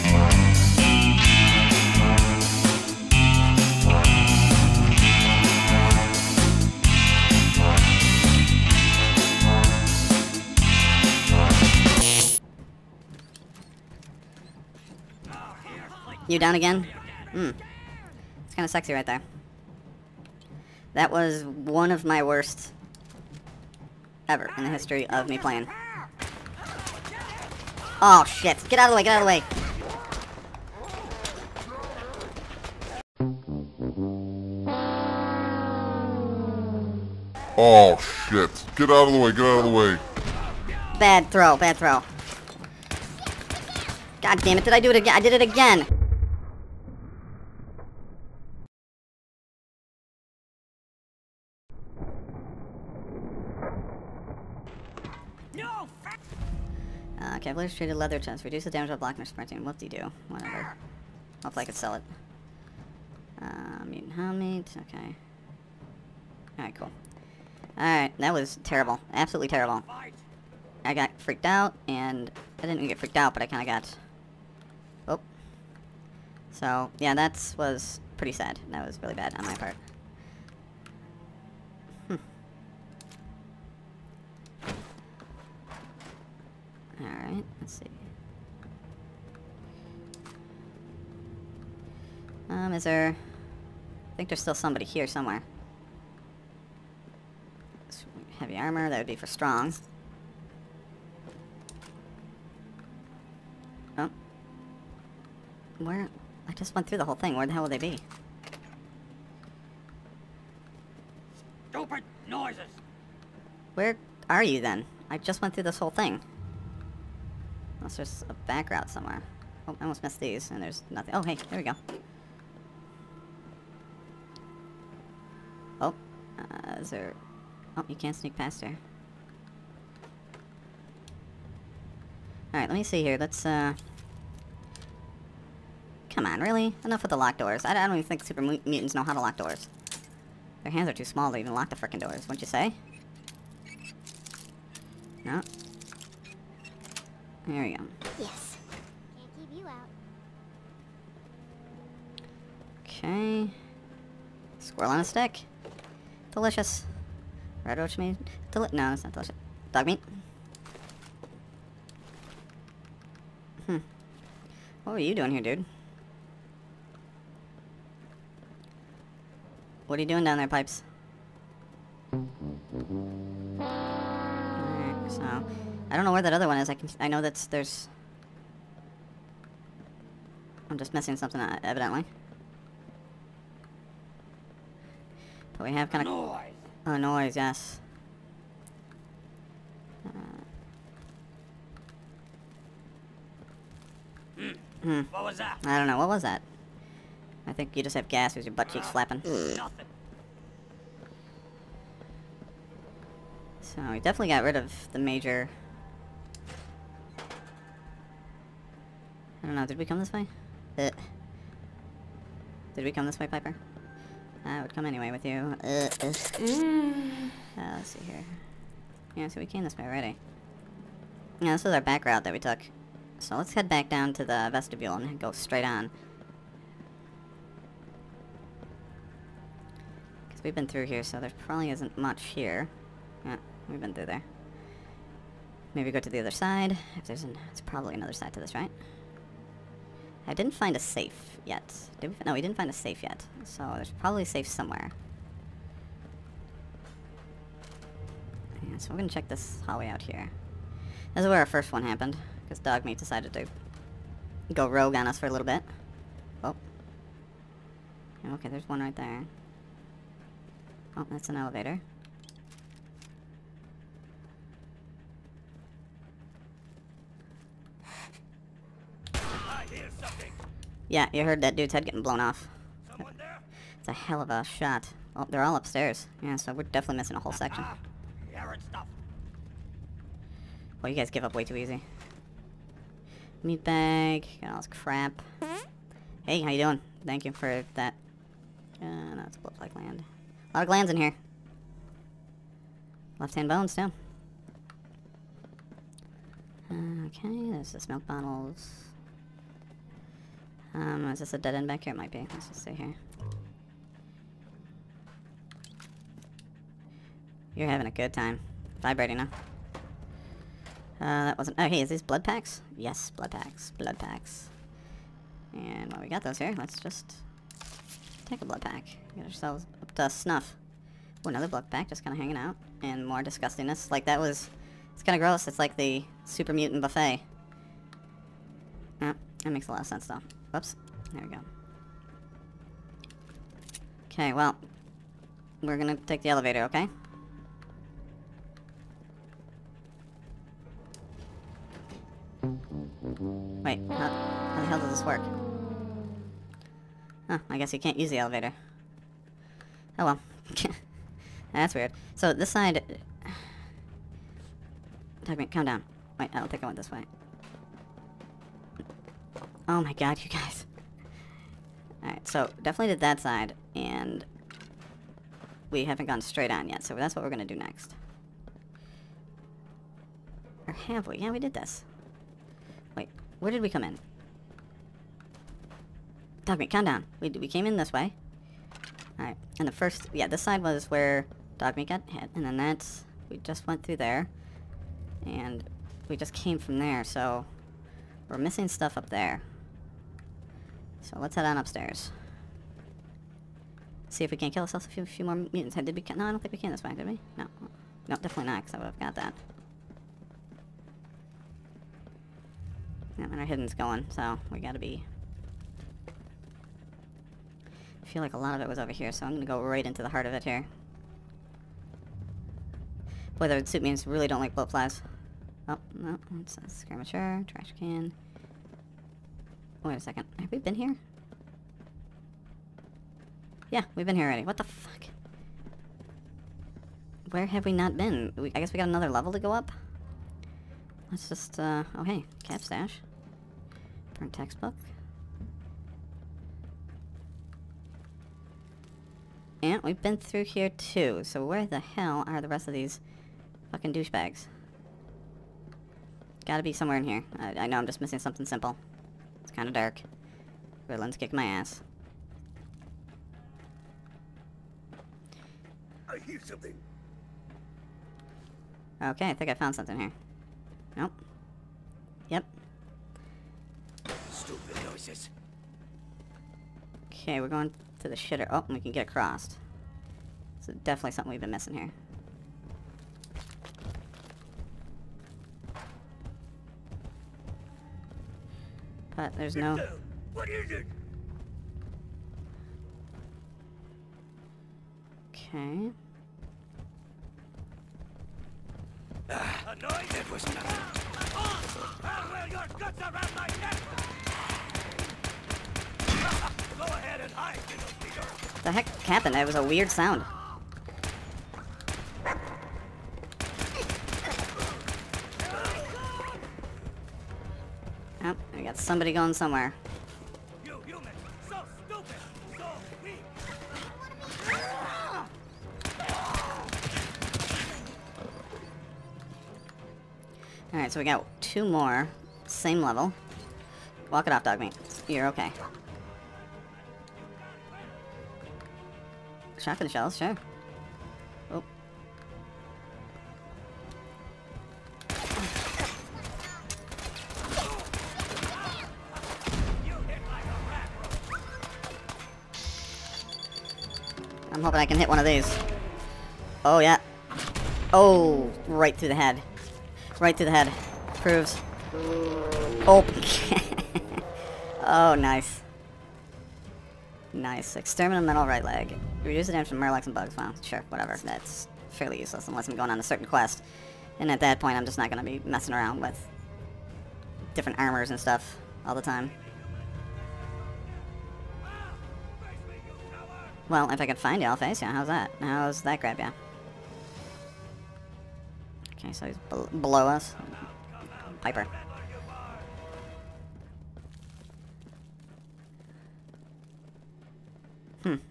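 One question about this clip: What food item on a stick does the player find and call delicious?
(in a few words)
Squirrel.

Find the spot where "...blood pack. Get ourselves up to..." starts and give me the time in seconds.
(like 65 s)
318 s.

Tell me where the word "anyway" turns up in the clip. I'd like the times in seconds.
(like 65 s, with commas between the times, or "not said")
214 s.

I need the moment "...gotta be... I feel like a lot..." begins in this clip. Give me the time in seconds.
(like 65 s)
404 s.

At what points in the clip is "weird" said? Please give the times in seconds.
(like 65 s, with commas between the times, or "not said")
351 s, 499 s.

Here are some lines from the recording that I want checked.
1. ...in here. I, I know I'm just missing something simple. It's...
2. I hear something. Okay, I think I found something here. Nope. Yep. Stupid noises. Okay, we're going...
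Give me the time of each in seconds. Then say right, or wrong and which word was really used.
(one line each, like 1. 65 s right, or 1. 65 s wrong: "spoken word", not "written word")
1. 446 s right
2. 456 s right.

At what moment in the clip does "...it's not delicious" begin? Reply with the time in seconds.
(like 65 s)
158 s.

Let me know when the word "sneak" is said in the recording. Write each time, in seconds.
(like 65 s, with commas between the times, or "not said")
128 s.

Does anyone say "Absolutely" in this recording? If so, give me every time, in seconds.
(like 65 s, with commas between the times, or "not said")
69 s.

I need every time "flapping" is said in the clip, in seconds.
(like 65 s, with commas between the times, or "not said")
198 s.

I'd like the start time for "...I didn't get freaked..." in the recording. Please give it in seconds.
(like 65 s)
72 s.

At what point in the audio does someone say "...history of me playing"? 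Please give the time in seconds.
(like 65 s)
24 s.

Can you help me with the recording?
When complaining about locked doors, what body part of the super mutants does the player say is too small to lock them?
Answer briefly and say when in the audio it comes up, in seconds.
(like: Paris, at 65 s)
Their hands, at 140 s.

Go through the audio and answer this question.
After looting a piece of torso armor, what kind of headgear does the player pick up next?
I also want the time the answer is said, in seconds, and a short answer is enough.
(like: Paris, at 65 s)
Mutant helmet, at 63 s.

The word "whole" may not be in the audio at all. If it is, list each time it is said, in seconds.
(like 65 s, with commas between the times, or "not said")
107 s, 115 s, 277 s.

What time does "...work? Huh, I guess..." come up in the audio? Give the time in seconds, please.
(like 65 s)
345 s.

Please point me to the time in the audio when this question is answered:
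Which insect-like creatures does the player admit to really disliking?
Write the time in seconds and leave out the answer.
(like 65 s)
414 s.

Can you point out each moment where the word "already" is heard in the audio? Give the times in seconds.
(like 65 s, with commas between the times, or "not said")
219 s, 424 s.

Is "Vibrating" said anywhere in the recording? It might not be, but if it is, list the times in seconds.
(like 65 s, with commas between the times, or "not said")
308 s.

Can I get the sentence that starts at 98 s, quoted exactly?
Heavy armor, that would be for strong.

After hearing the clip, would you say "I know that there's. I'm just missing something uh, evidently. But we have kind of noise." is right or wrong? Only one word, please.
right.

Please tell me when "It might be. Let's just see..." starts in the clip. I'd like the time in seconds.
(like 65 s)
301 s.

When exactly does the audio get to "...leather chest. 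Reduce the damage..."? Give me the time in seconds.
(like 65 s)
57 s.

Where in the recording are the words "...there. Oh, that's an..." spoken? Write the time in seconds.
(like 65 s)
258 s.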